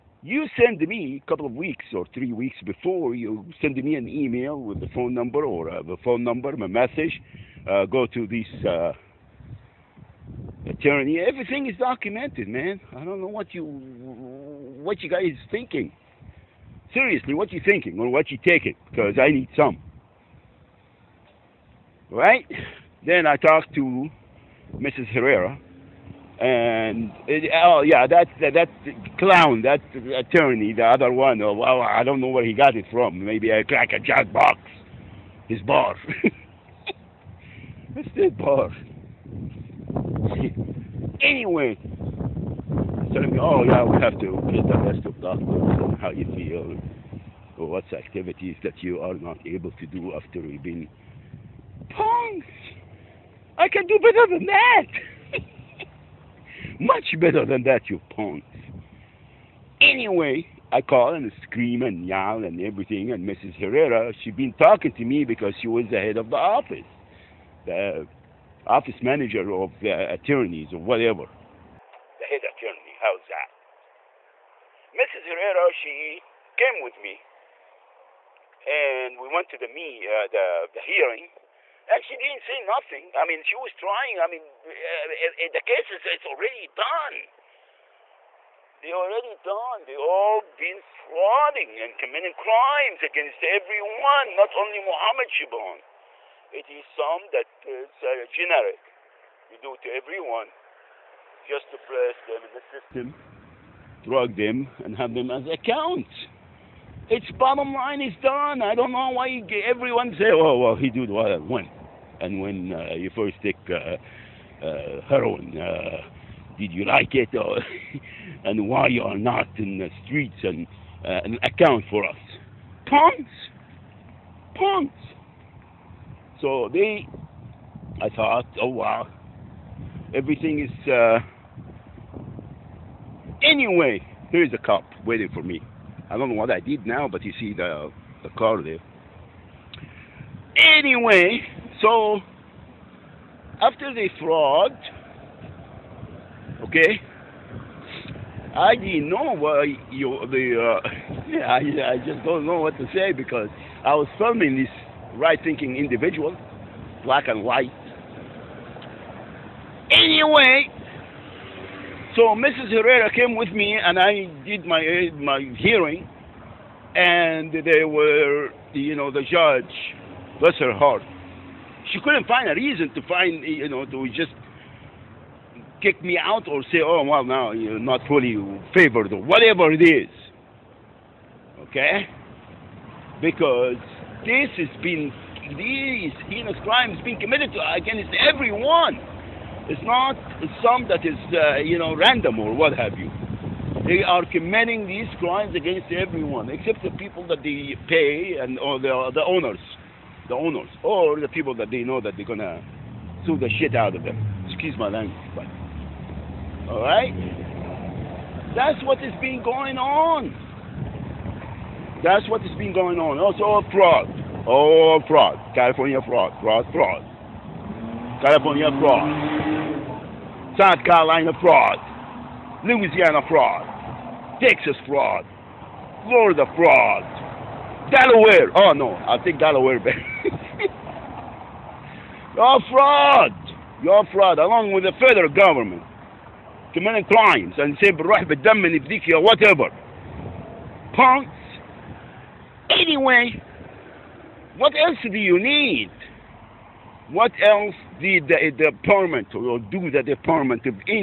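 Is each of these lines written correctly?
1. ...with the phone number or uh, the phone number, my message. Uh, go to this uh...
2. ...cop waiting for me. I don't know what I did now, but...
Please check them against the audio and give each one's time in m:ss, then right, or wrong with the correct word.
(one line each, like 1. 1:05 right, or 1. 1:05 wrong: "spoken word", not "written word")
1. 0:04 right
2. 2:14 right.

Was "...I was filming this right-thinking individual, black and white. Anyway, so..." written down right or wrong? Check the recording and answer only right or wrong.
right.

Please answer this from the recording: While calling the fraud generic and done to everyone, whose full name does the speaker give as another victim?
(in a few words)
Mohammed Shibon.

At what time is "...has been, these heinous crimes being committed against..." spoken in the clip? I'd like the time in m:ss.
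3:04.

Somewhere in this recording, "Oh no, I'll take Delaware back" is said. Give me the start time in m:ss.
3:48.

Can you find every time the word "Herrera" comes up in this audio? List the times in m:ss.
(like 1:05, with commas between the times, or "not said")
0:25, 1:03, 1:15, 2:42.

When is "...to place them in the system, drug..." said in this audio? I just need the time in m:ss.
1:41.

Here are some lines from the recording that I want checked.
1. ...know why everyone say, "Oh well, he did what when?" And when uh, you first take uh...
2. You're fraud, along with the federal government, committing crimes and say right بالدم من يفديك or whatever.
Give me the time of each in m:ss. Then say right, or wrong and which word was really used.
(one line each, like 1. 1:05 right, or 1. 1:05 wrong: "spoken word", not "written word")
1. 1:48 right
2. 3:53 right.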